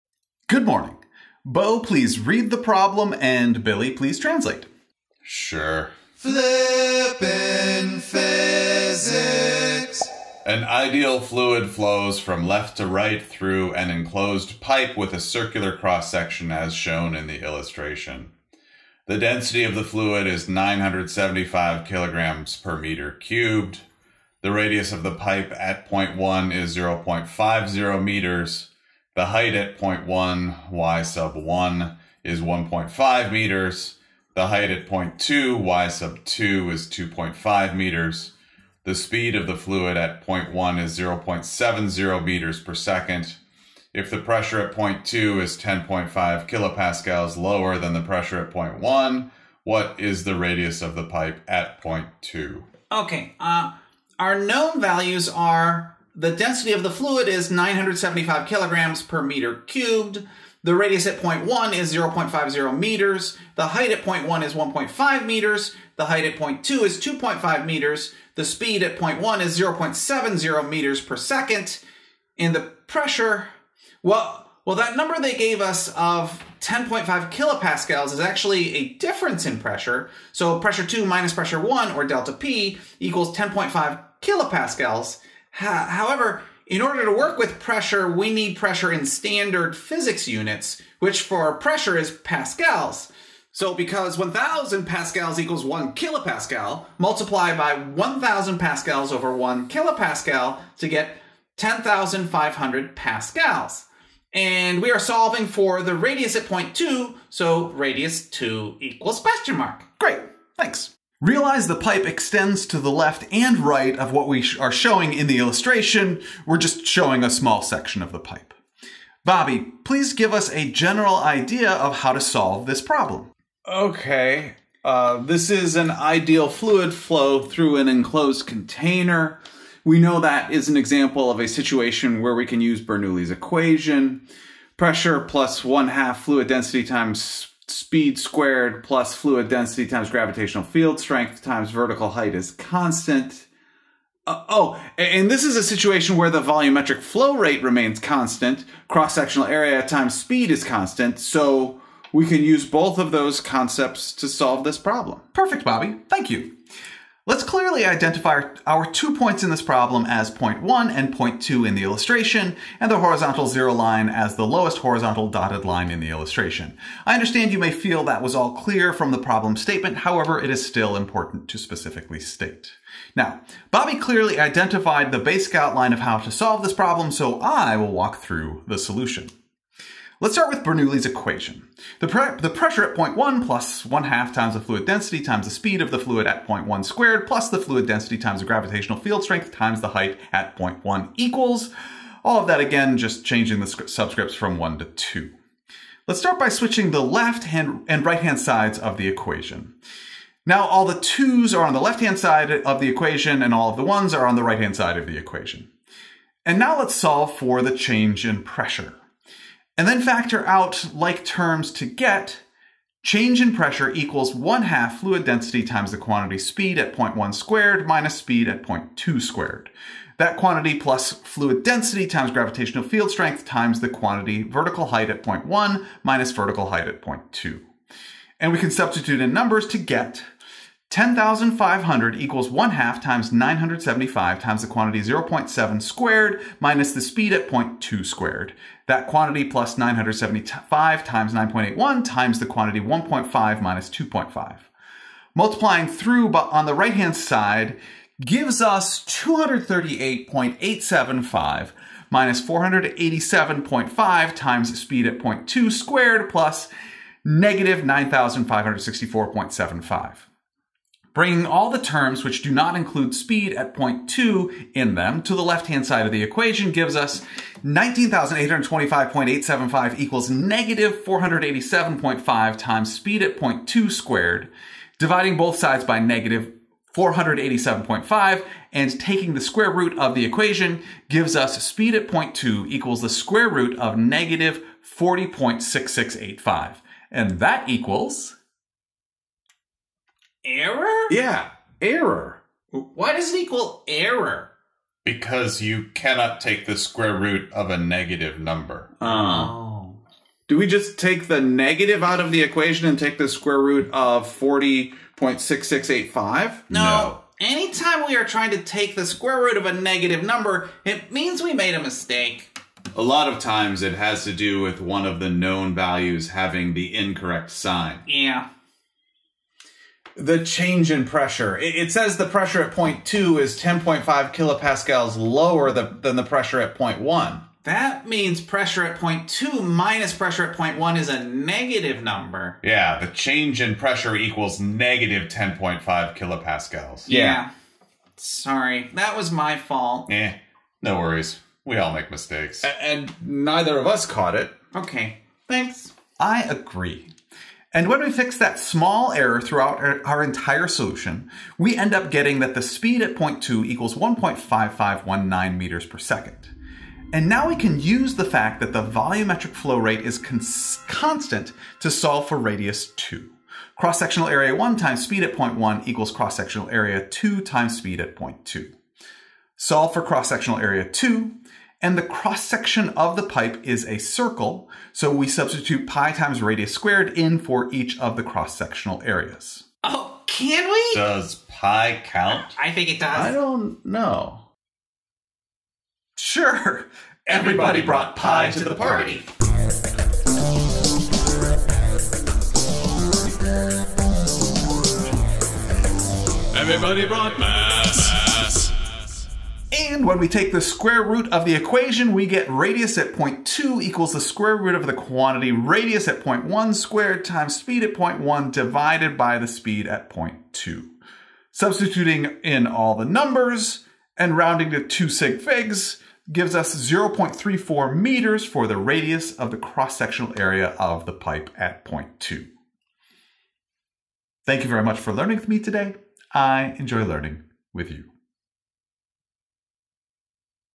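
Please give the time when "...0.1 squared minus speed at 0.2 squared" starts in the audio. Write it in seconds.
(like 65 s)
216 s.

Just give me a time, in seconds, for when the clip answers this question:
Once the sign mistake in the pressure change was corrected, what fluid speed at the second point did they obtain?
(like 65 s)
353 s.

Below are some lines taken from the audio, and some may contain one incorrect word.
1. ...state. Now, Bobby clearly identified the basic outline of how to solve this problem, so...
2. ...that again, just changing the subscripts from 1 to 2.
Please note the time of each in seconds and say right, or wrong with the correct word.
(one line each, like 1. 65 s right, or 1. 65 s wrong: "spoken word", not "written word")
1. 172 s right
2. 192 s right.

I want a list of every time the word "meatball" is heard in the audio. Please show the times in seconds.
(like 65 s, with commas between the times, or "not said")
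not said.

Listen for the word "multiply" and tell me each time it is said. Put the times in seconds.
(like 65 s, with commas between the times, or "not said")
96 s.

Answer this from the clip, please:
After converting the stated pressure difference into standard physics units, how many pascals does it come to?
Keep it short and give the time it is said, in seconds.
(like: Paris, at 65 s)
10,500 pascals, at 101 s.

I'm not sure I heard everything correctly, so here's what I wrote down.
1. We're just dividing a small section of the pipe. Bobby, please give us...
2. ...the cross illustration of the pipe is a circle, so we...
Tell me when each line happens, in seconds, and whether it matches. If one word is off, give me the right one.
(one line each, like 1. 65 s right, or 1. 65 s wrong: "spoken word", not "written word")
1. 116 s wrong: "showing", not "dividing"
2. 371 s wrong: "section", not "illustration".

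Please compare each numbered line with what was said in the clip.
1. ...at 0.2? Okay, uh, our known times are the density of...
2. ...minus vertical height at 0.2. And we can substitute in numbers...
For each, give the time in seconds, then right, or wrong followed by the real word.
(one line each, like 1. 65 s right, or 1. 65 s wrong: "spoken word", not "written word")
1. 51 s wrong: "values", not "times"
2. 226 s right.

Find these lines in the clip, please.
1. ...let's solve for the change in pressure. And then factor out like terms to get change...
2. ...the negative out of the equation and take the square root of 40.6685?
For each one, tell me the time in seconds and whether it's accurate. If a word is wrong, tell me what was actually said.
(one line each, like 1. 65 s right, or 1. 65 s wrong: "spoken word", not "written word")
1. 206 s right
2. 301 s right.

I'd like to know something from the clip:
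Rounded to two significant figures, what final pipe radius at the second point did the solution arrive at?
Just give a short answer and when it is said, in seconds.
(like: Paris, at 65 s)
0.34 meters, at 416 s.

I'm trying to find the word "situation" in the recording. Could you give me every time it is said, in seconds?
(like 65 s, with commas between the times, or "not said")
131 s, 145 s.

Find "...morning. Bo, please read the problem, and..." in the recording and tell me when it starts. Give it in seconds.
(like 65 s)
0 s.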